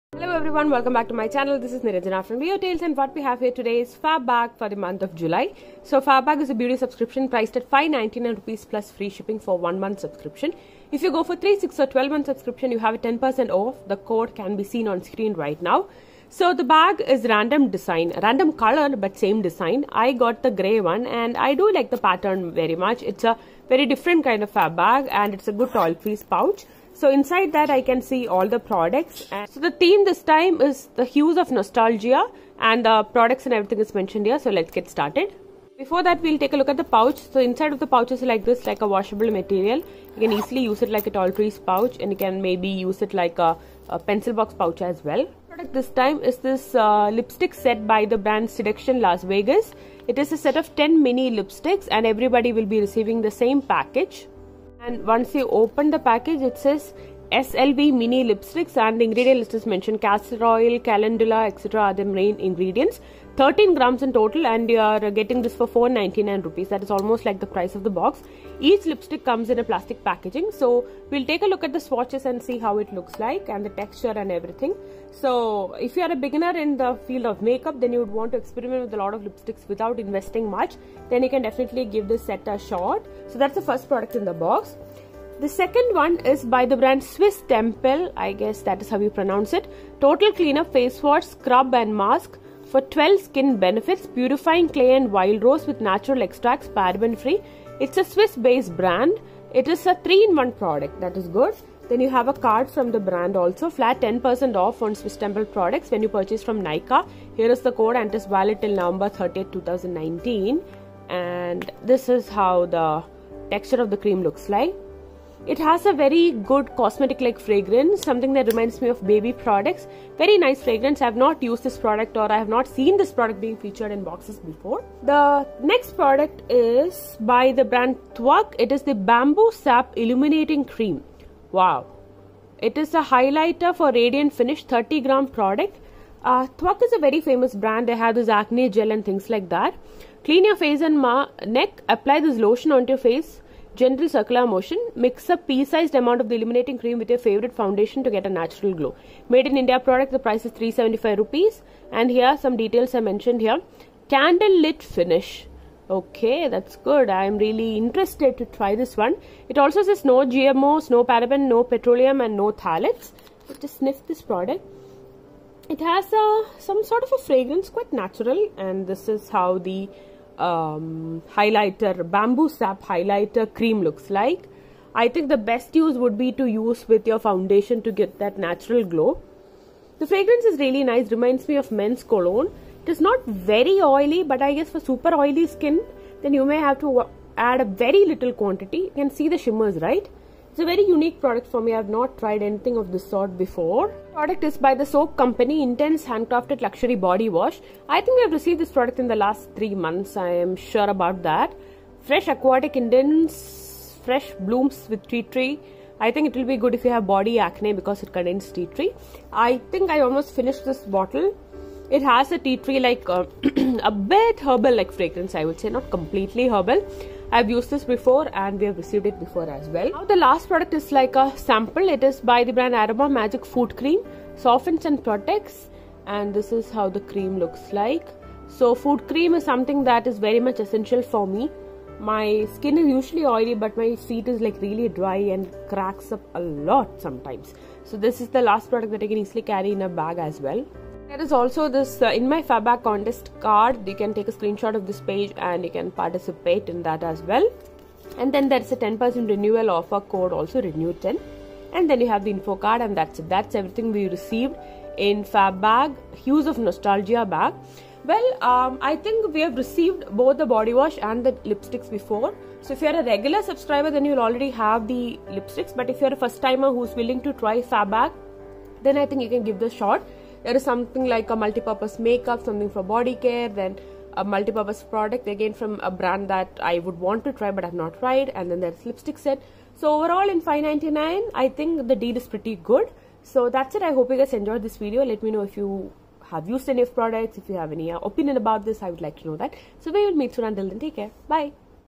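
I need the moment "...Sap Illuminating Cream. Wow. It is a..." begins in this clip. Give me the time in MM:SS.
02:09.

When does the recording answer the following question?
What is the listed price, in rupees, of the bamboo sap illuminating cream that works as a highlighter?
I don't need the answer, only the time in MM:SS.
02:30.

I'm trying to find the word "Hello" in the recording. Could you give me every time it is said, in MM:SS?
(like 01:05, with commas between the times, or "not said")
00:00.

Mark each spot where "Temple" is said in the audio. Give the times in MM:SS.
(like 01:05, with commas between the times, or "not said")
01:27, 01:45.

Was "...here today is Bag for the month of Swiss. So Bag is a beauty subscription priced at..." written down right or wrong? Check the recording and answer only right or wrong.
wrong.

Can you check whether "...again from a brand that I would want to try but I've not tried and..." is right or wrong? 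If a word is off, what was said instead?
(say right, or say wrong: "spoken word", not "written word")
right.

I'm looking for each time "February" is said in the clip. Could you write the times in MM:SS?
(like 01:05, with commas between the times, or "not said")
not said.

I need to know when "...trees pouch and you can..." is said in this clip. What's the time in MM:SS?
00:41.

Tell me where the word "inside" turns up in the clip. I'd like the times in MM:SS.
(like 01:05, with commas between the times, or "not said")
00:27, 00:37.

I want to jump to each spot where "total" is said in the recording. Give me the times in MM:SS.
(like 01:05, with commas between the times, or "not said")
01:04, 01:29.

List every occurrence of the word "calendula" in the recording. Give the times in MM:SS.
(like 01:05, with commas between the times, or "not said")
01:00.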